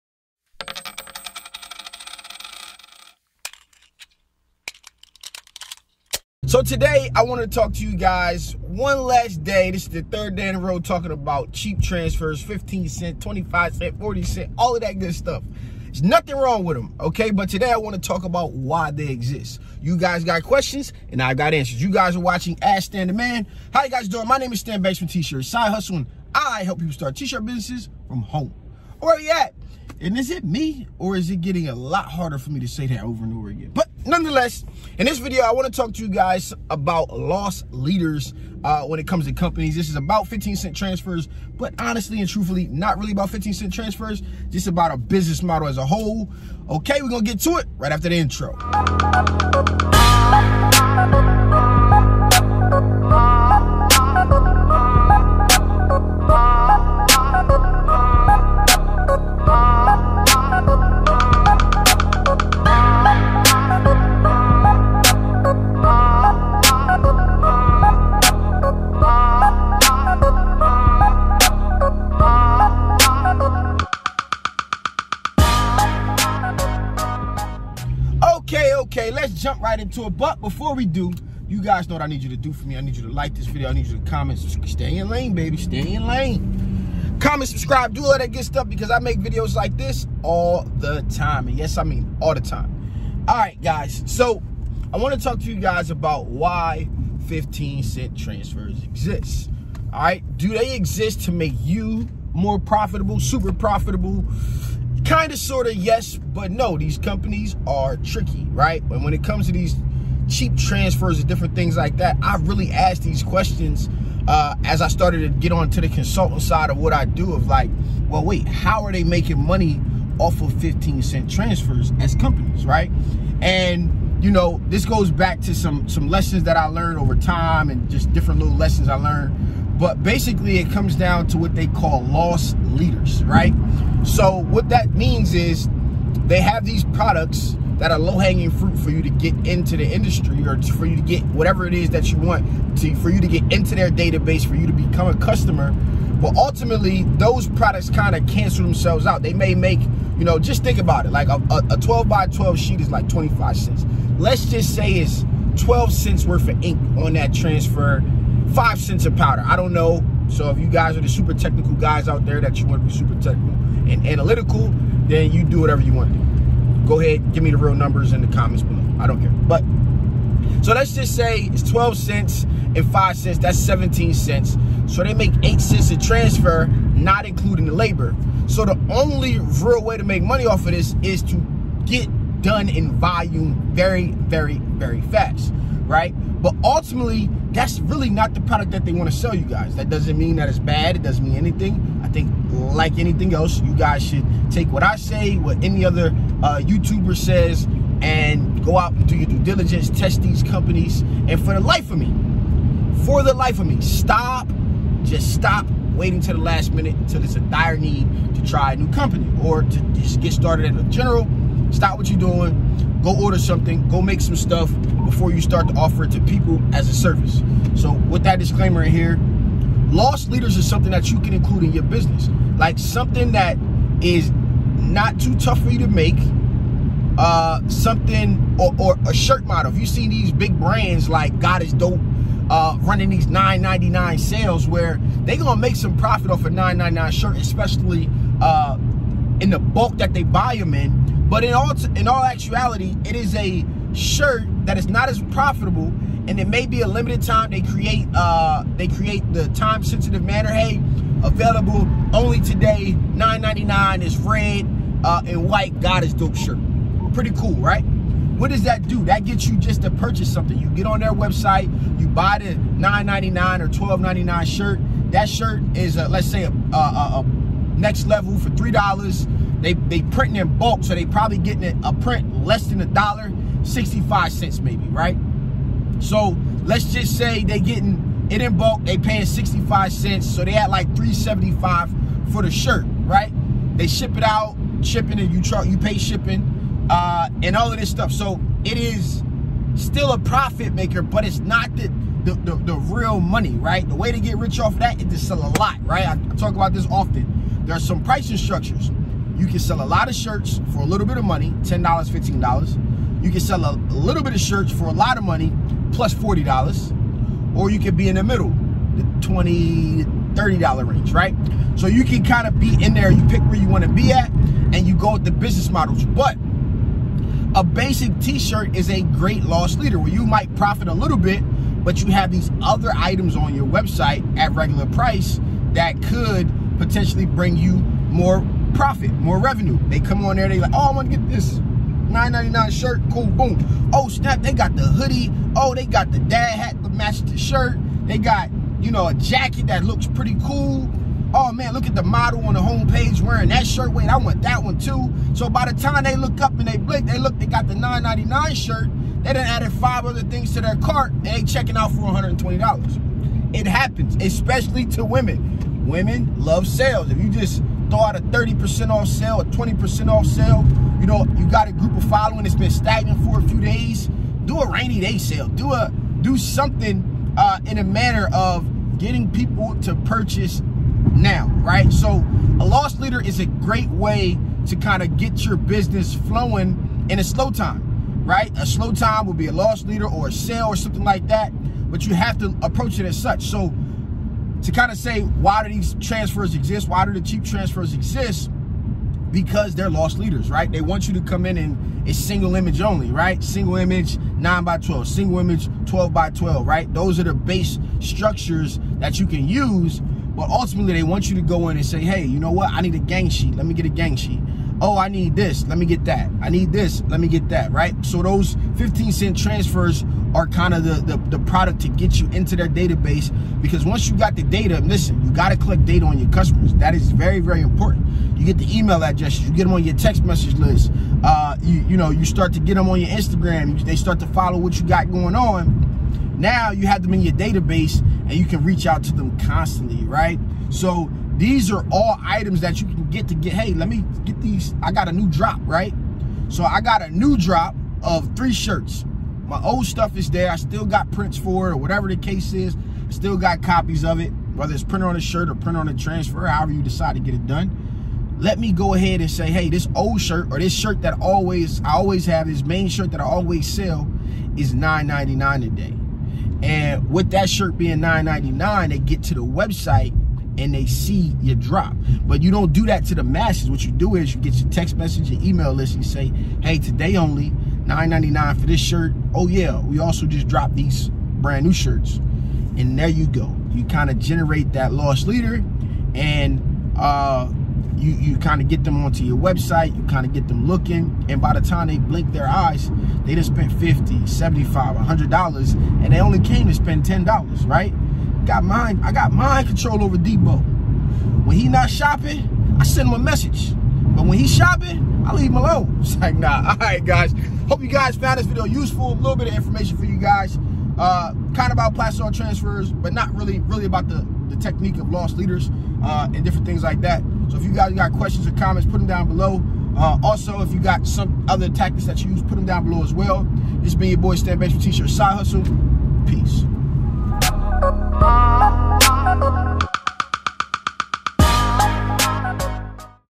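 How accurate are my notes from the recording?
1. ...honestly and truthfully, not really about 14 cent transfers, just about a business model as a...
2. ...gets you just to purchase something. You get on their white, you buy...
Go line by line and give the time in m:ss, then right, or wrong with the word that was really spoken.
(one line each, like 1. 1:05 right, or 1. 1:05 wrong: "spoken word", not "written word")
1. 0:41 wrong: "15", not "14"
2. 4:19 wrong: "website", not "white".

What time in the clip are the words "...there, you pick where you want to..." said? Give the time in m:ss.
5:12.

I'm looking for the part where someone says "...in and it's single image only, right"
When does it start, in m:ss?
6:31.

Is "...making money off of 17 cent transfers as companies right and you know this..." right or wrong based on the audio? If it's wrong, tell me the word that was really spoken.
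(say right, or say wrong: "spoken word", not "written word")
wrong: "15", not "17".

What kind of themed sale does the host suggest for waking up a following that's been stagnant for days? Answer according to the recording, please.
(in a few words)
Rainy day sale.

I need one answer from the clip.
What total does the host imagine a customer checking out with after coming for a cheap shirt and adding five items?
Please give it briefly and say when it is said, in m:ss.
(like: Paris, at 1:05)
$120, at 5:52.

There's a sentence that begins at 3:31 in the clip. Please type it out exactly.
Stop what you're doing go order something, go make some stuff before you start to offer it to people as a service.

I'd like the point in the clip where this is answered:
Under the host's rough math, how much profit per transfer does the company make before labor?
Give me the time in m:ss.
2:55.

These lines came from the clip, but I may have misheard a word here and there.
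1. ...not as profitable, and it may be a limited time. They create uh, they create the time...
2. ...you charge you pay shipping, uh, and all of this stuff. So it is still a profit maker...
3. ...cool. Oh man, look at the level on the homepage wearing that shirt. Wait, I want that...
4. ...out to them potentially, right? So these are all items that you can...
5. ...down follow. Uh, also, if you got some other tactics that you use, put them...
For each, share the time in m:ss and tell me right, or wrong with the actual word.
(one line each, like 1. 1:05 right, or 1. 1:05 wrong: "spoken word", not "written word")
1. 4:04 right
2. 4:45 right
3. 5:40 wrong: "model", not "level"
4. 7:08 wrong: "constantly", not "potentially"
5. 8:29 wrong: "below", not "follow".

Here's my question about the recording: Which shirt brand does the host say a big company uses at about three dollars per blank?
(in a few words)
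Next Level.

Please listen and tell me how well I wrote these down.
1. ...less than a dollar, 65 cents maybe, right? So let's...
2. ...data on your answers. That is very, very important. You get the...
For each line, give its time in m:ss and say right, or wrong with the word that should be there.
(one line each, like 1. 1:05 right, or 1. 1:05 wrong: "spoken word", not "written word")
1. 4:32 right
2. 6:55 wrong: "customers", not "answers".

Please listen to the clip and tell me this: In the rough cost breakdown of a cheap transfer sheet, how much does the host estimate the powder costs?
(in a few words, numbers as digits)
5 cents.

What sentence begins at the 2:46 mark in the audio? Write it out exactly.
Go ahead, give me the real numbers in the comments below.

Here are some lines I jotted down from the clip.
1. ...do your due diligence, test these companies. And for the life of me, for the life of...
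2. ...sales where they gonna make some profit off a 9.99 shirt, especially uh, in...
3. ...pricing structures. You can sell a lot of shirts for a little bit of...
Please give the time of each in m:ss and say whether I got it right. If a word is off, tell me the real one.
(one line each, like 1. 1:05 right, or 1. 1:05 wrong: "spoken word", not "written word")
1. 3:19 right
2. 3:54 right
3. 4:58 right.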